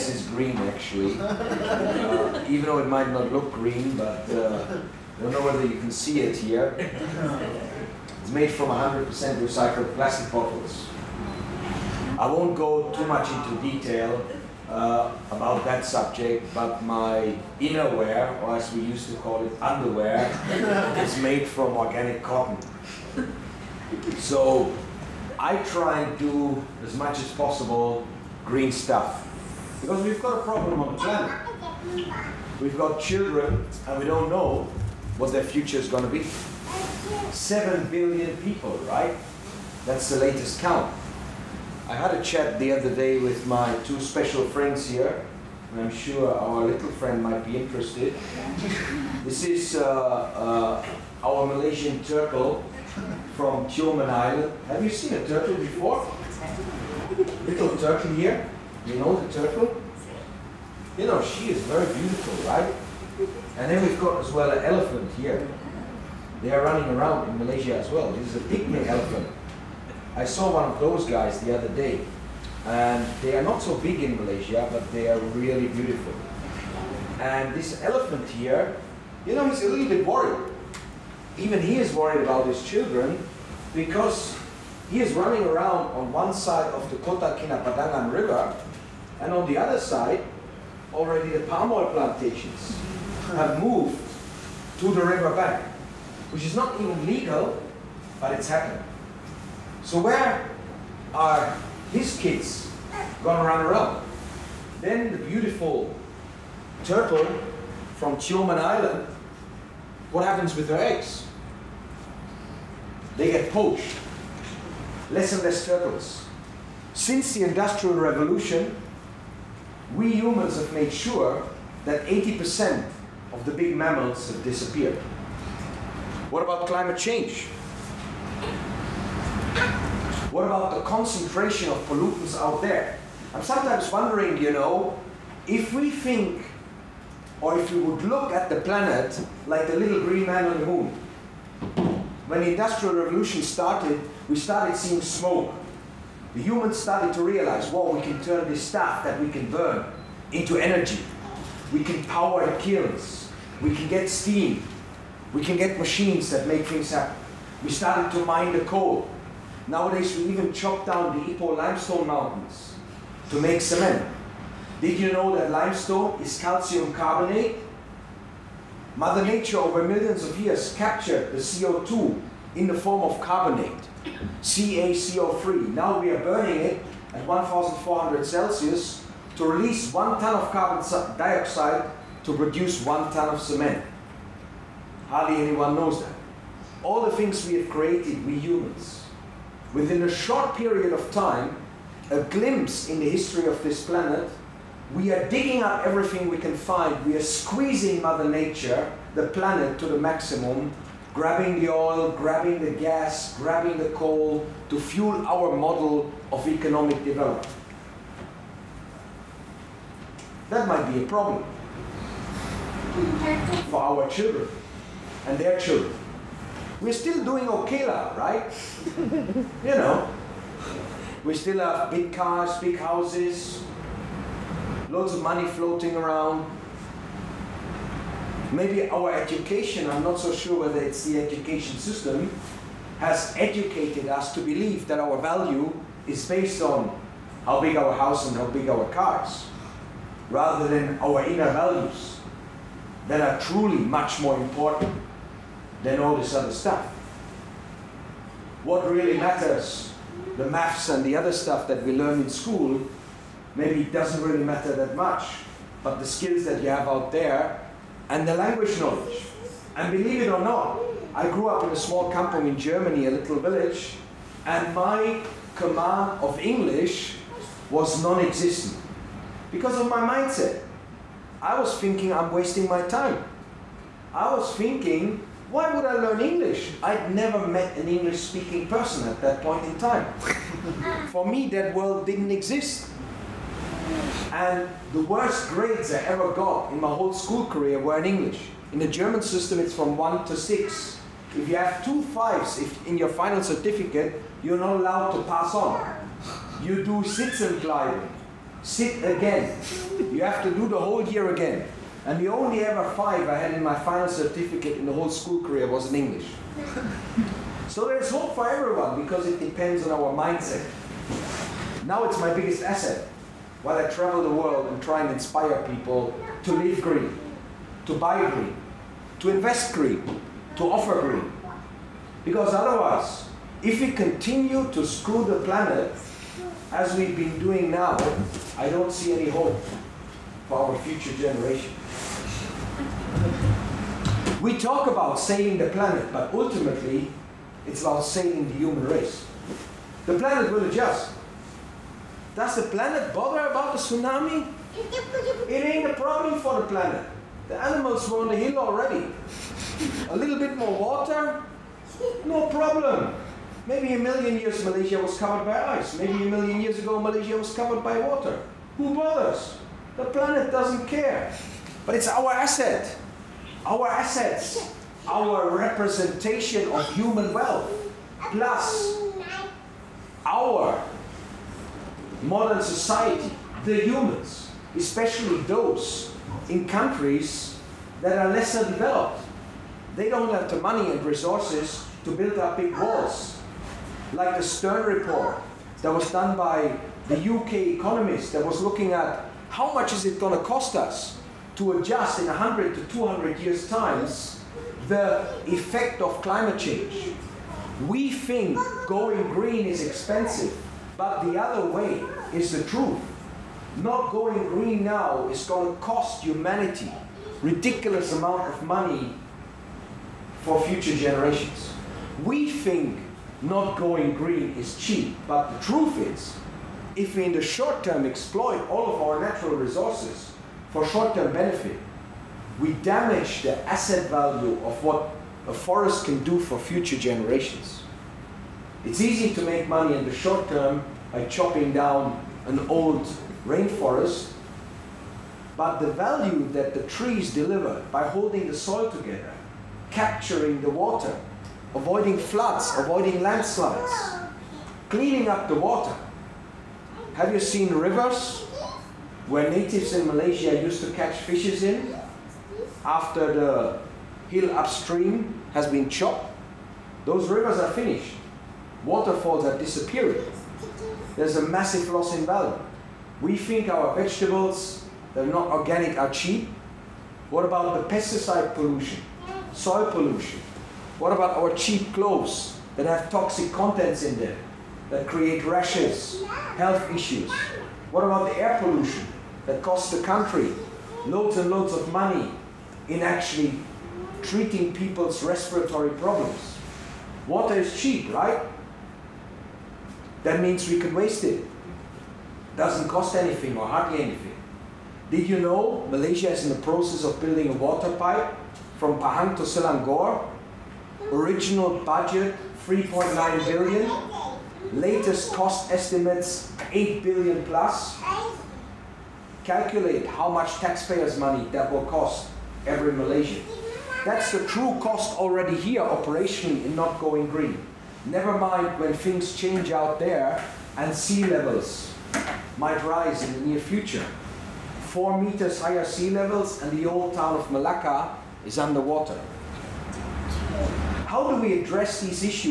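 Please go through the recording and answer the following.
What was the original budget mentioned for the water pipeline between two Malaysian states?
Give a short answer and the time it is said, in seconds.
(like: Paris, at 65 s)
3.9 billion, at 502 s.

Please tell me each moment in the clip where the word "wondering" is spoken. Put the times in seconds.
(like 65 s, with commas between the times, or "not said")
133 s.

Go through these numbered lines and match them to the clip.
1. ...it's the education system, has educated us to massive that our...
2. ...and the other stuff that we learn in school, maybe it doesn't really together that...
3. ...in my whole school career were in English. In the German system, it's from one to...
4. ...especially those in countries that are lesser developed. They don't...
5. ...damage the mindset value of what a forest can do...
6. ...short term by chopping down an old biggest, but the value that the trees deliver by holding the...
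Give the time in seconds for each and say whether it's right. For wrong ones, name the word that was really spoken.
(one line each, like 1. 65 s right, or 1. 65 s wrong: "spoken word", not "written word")
1. 230 s wrong: "believe", not "massive"
2. 250 s wrong: "matter", not "together"
3. 286 s right
4. 374 s right
5. 422 s wrong: "asset", not "mindset"
6. 430 s wrong: "rainforest", not "biggest".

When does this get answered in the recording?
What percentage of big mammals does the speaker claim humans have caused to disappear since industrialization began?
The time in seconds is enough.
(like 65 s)
122 s.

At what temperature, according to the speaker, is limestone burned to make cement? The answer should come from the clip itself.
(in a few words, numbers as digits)
1,400 Celsius.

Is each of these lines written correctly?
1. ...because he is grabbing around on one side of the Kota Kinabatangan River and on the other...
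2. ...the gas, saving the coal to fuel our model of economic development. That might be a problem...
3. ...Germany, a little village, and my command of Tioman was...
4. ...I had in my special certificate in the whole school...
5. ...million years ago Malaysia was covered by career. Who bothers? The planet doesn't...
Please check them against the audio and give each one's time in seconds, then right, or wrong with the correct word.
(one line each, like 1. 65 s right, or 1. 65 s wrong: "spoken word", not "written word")
1. 83 s wrong: "running", not "grabbing"
2. 202 s wrong: "grabbing", not "saving"
3. 262 s wrong: "English", not "Tioman"
4. 303 s wrong: "final", not "special"
5. 356 s wrong: "water", not "career".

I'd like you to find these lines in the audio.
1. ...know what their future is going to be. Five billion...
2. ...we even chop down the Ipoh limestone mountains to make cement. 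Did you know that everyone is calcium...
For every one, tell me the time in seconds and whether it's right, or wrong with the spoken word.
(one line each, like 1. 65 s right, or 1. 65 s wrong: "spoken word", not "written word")
1. 34 s wrong: "Seven", not "Five"
2. 160 s wrong: "limestone", not "everyone".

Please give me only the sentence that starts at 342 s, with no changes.
Does the planet bother about the tsunami?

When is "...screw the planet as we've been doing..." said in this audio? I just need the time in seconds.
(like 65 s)
324 s.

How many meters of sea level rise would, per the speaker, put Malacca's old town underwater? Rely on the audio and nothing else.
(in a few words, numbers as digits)
4.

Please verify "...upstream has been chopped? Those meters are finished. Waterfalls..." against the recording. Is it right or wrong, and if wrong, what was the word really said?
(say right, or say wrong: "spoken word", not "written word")
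wrong: "rivers", not "meters".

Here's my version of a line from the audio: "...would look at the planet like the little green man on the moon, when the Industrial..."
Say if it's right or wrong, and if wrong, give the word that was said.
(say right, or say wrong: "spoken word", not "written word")
right.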